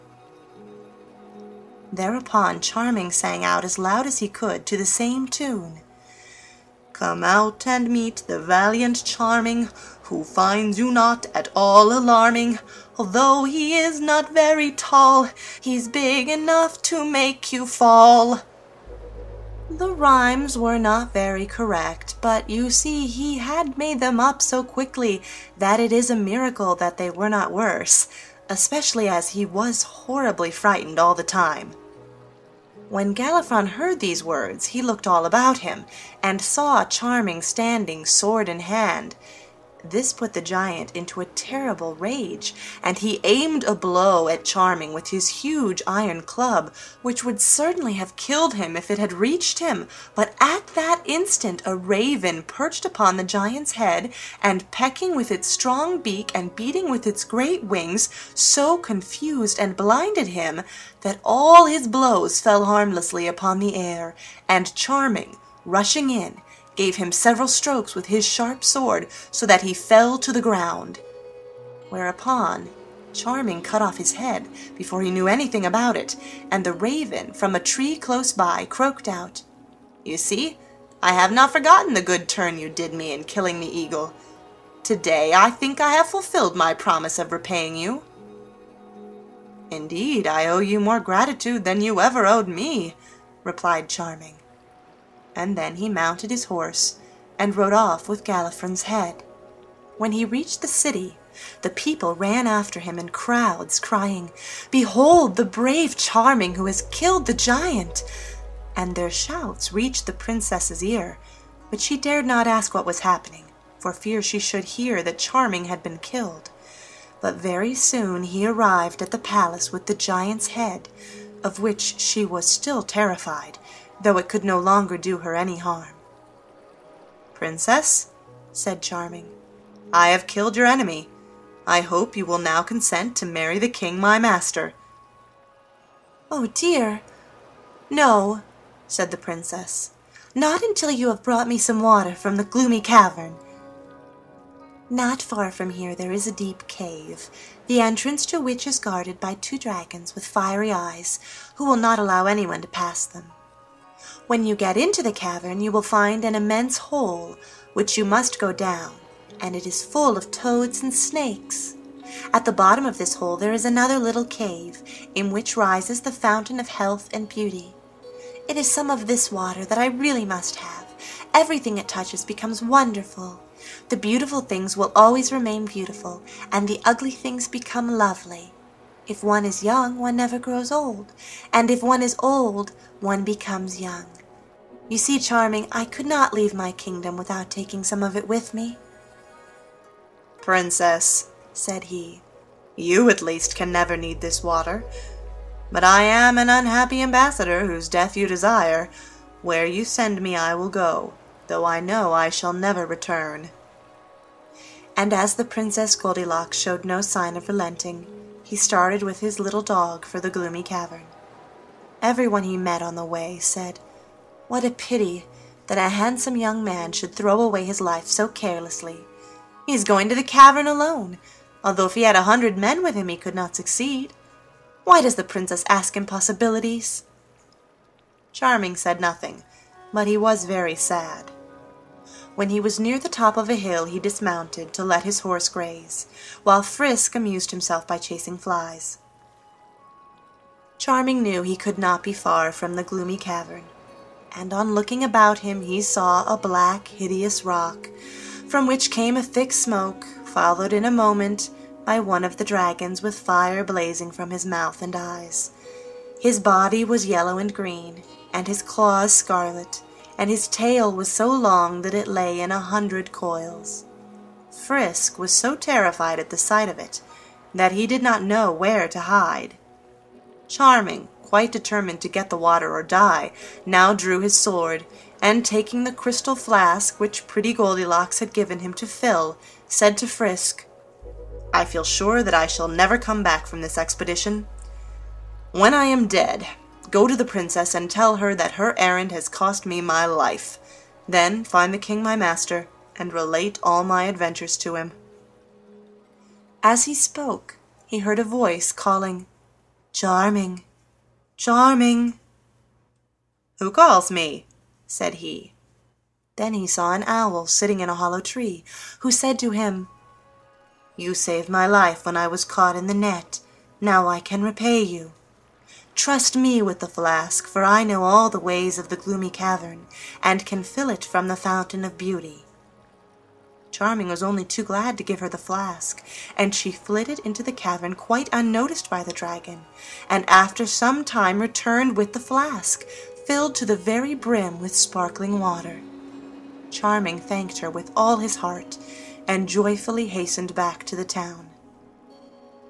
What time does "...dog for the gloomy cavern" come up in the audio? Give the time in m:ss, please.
3:29.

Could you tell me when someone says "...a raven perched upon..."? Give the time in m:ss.
0:51.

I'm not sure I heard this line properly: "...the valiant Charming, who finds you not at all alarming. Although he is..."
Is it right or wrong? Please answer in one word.
right.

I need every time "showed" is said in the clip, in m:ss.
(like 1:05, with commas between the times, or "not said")
3:26.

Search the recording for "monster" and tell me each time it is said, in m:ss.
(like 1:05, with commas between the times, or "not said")
not said.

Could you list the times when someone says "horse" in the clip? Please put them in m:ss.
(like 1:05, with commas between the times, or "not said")
1:36, 3:55.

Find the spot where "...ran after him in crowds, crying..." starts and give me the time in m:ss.
1:42.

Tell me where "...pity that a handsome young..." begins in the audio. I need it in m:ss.
3:34.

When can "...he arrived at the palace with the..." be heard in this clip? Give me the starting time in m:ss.
1:58.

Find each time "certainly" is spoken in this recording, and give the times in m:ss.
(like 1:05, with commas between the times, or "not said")
0:47.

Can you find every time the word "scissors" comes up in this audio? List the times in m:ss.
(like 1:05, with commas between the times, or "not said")
not said.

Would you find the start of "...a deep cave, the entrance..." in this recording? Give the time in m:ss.
2:26.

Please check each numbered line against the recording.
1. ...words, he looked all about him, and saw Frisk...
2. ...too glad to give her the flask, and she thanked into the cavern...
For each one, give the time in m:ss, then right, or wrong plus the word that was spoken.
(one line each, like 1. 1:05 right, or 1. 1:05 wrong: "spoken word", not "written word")
1. 0:34 wrong: "Charming", not "Frisk"
2. 5:24 wrong: "flitted", not "thanked".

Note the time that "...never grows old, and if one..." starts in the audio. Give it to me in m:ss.
3:00.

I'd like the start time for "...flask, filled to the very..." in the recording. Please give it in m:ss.
5:32.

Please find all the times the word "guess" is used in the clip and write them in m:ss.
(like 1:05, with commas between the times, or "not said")
not said.